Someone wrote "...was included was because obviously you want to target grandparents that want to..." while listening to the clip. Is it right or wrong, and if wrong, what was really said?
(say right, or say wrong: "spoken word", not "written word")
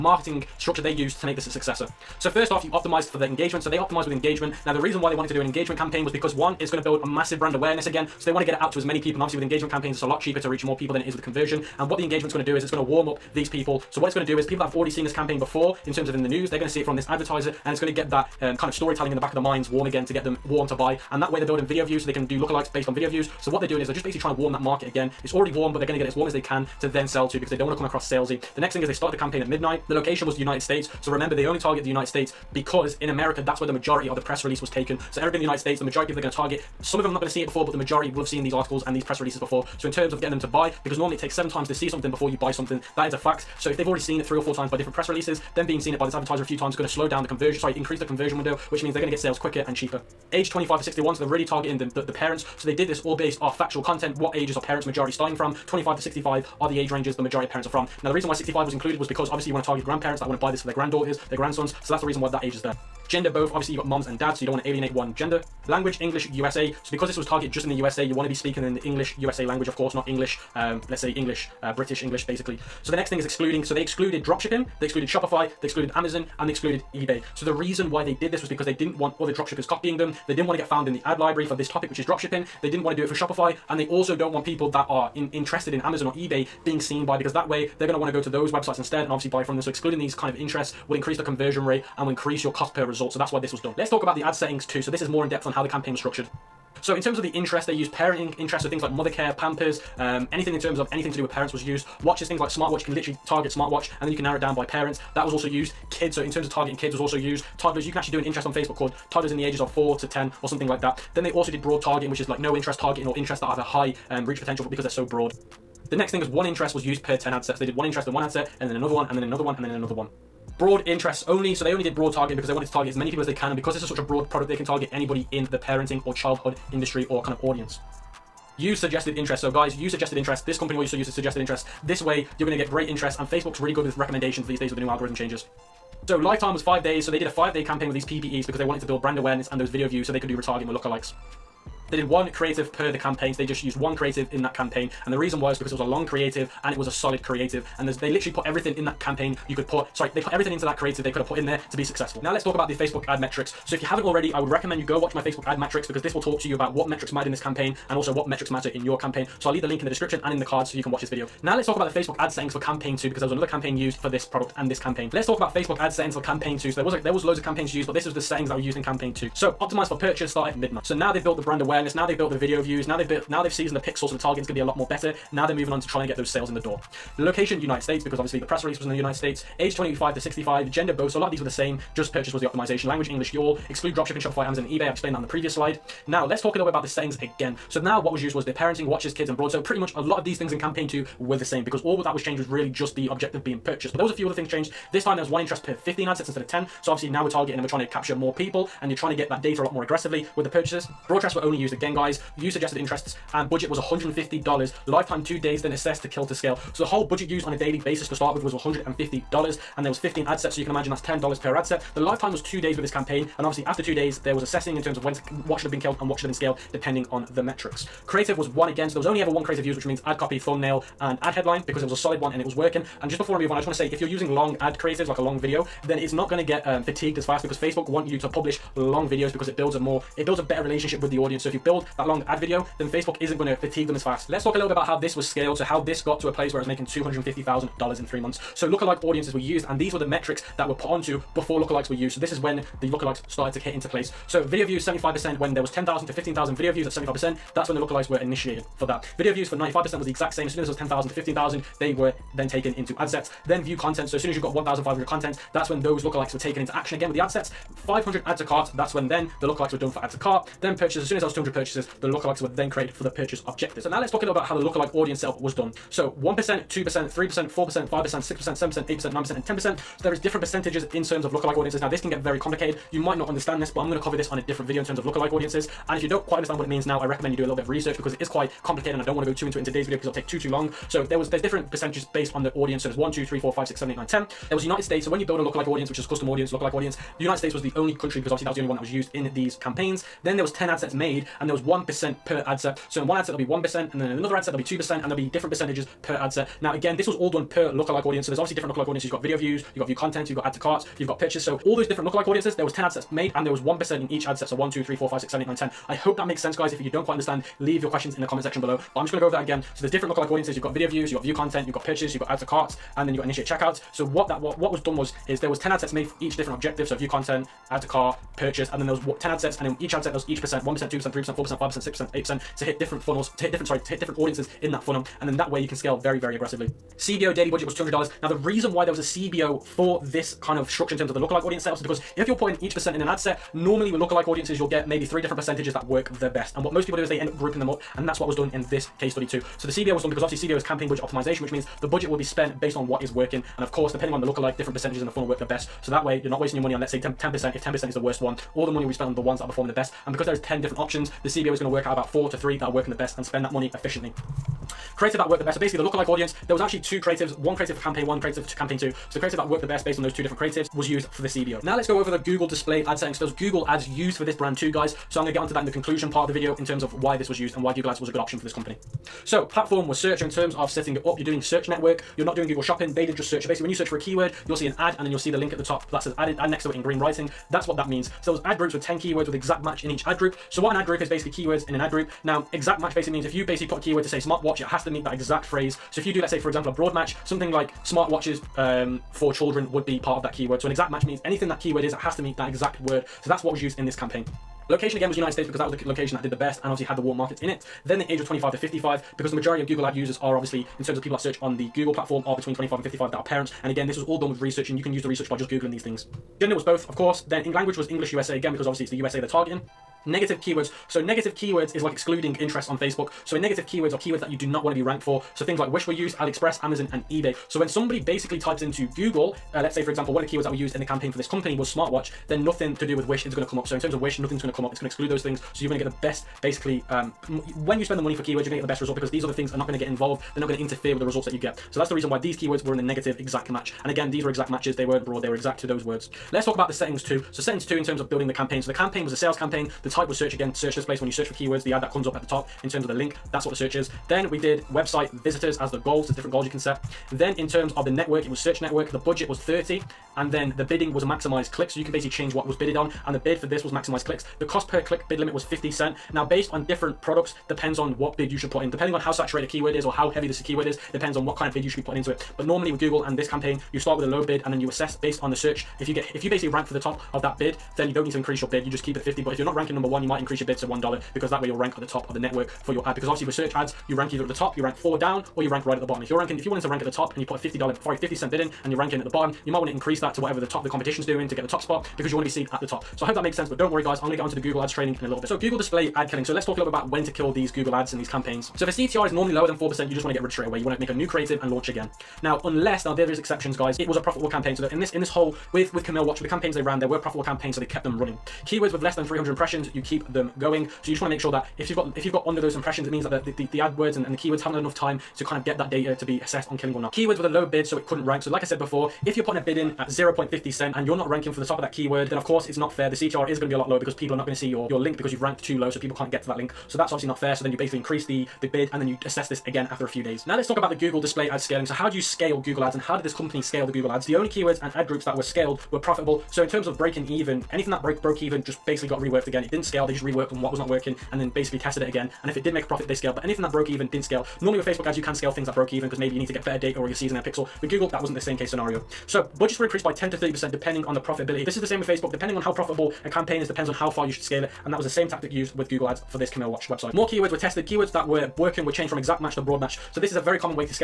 right.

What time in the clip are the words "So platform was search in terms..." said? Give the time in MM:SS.
06:09.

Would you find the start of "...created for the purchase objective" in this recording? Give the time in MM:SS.
04:22.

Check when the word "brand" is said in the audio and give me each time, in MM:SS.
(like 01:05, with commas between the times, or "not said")
00:07, 02:19, 02:51, 06:04.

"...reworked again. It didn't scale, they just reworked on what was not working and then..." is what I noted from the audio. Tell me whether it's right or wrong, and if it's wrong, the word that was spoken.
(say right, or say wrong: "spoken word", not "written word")
right.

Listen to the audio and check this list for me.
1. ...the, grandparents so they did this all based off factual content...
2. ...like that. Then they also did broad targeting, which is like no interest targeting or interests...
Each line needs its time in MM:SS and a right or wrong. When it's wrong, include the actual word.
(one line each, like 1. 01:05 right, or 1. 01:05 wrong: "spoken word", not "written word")
1. 00:52 wrong: "parents", not "grandparents"
2. 01:50 right.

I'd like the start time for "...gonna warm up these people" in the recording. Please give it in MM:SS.
00:12.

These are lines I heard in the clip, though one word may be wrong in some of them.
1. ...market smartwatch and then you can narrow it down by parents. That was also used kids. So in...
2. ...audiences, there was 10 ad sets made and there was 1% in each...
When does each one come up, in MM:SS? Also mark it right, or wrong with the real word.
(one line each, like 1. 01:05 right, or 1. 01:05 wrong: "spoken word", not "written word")
1. 01:43 wrong: "target", not "market"
2. 05:02 right.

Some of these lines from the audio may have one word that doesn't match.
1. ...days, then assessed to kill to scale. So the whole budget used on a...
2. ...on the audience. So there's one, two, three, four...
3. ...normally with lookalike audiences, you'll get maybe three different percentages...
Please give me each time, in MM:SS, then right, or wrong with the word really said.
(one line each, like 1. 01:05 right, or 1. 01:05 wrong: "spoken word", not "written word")
1. 03:25 right
2. 04:42 right
3. 05:33 right.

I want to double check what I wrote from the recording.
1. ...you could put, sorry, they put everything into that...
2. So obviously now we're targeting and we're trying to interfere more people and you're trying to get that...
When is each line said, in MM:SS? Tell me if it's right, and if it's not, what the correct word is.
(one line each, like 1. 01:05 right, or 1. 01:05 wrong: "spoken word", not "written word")
1. 02:29 right
2. 03:16 wrong: "capture", not "interfere".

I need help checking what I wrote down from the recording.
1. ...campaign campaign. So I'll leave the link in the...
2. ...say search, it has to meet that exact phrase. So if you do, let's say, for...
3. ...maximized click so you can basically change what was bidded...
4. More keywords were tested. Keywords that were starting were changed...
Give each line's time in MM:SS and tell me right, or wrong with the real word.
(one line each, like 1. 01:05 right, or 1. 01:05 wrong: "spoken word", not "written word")
1. 02:38 right
2. 06:24 wrong: "smartwatch", not "search"
3. 07:31 right
4. 09:06 wrong: "working", not "starting".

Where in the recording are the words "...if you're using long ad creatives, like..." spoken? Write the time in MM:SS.
03:43.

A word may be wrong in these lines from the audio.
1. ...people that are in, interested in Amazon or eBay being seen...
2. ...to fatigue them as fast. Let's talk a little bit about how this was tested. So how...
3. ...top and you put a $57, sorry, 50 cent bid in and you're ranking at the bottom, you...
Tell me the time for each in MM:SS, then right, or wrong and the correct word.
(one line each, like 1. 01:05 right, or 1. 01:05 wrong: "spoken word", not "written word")
1. 01:24 right
2. 03:53 wrong: "scaled", not "tested"
3. 07:56 wrong: "50", not "57".